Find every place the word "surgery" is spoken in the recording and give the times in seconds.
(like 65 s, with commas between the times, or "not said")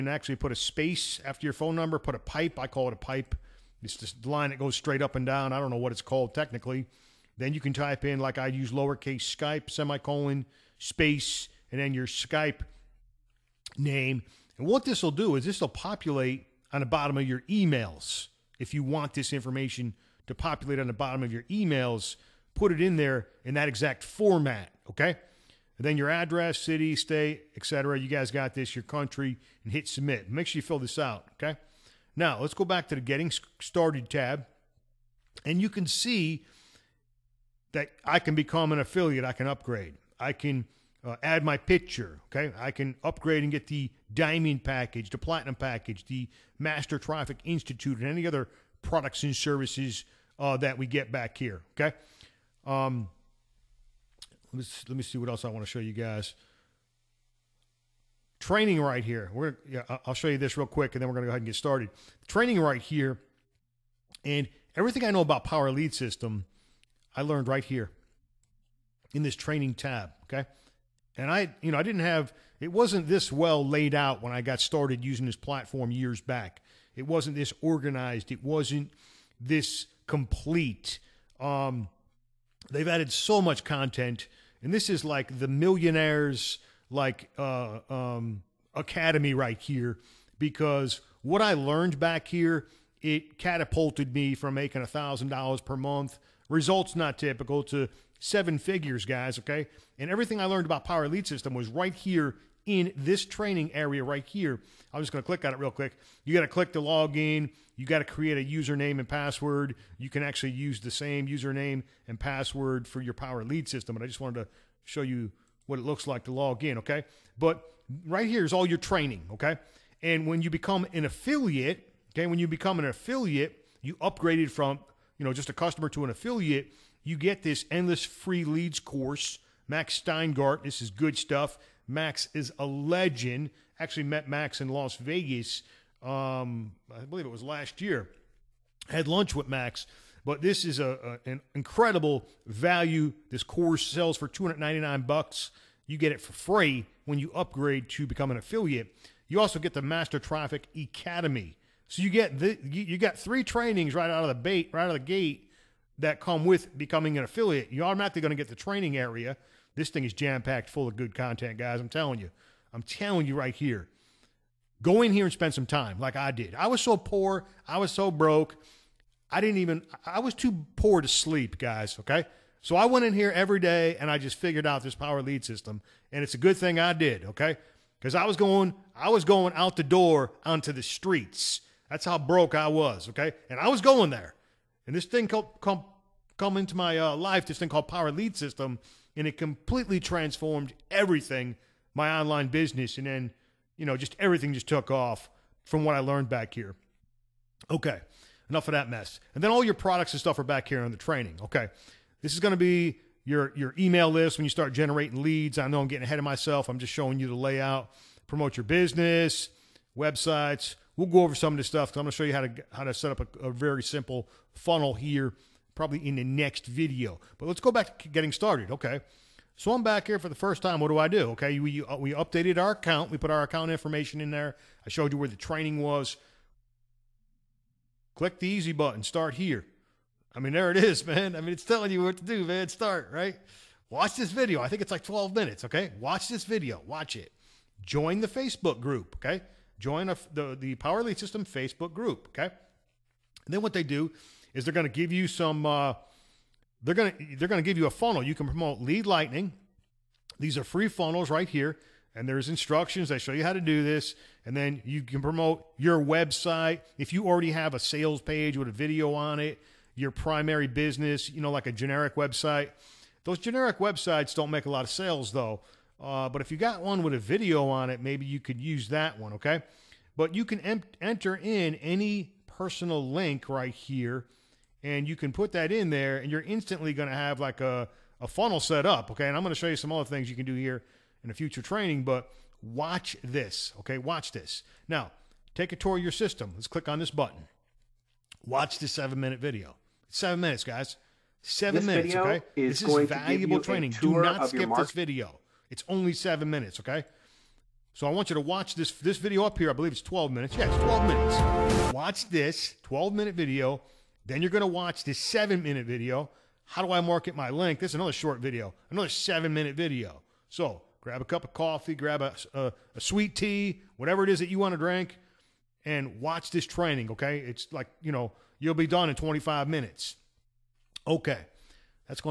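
not said.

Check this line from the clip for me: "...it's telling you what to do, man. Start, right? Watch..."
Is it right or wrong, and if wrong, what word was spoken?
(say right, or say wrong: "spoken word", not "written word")
right.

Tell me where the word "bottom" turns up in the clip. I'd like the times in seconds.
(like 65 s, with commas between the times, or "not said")
16 s, 20 s.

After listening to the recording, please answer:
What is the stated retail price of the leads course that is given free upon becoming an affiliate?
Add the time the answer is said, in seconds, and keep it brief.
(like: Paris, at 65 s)
$299, at 144 s.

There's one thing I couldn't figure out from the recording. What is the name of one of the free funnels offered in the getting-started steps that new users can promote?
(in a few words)
Lead Lightning.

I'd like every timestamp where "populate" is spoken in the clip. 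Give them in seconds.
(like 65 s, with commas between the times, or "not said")
15 s, 20 s.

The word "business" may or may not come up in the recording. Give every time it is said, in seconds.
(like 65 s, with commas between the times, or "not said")
192 s, 208 s, 260 s.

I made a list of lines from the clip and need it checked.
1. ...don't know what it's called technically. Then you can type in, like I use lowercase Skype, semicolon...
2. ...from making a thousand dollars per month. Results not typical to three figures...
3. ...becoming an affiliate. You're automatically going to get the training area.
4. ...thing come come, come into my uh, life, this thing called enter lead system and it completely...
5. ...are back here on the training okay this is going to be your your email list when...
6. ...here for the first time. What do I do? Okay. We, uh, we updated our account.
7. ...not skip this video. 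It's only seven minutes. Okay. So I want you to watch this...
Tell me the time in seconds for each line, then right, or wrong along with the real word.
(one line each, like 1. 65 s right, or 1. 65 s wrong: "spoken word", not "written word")
1. 5 s right
2. 94 s wrong: "seven", not "three"
3. 156 s right
4. 185 s wrong: "power", not "enter"
5. 200 s right
6. 220 s right
7. 294 s right.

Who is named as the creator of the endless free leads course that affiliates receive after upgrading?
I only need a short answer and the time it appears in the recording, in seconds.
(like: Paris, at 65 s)
Max Steingart, at 129 s.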